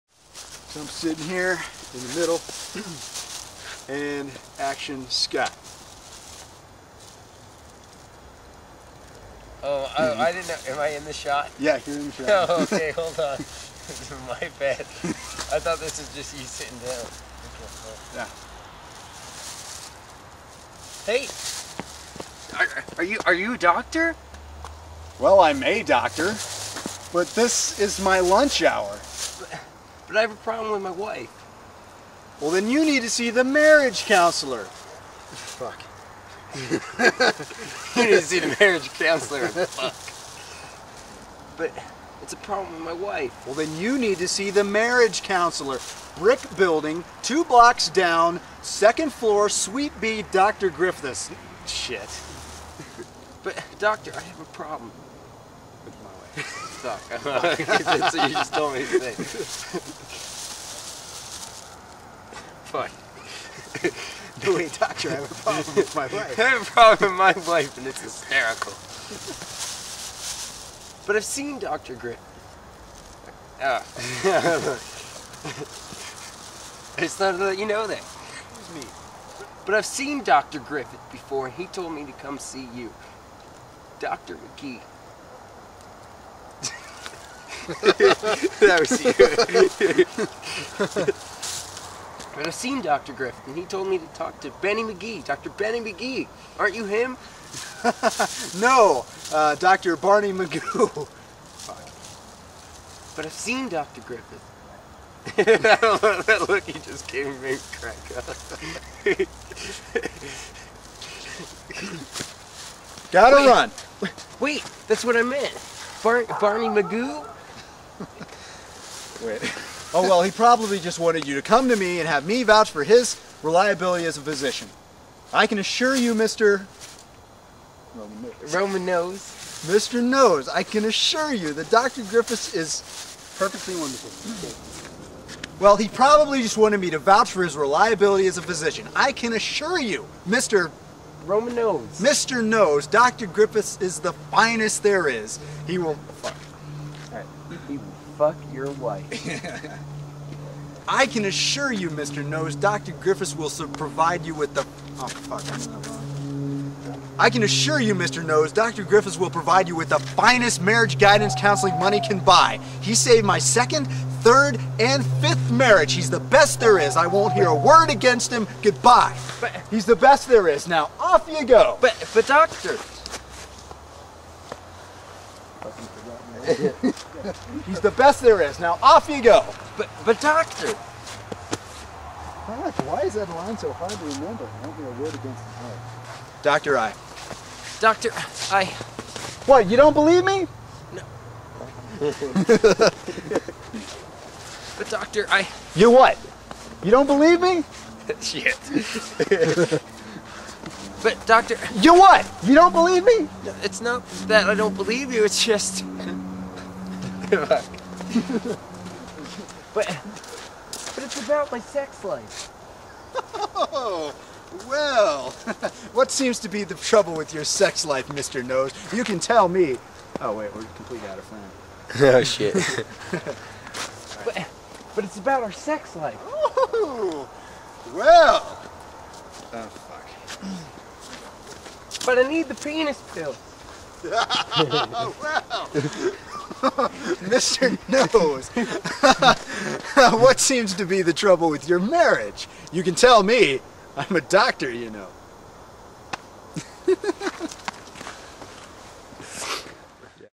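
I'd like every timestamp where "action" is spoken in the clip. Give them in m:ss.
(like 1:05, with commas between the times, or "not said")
0:04.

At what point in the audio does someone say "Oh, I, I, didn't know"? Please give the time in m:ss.
0:09.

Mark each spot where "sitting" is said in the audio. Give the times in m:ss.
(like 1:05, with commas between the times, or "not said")
0:00, 0:16.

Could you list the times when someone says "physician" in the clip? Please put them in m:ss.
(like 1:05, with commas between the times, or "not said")
2:04, 2:18.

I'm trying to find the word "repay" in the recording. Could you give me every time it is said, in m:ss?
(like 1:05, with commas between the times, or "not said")
not said.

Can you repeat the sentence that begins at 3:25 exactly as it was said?
It's just but, but it's about my sex life.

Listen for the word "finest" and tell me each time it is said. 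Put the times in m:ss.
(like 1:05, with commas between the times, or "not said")
2:24, 2:39.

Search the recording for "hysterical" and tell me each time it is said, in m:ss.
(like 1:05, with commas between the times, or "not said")
1:08.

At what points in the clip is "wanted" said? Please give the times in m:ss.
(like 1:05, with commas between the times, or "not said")
2:00, 2:16.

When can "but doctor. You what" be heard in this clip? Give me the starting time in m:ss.
3:21.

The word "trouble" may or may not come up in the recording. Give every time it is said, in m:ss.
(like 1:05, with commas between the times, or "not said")
3:36, 4:01.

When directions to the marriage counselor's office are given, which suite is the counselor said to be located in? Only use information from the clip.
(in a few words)
Suite B.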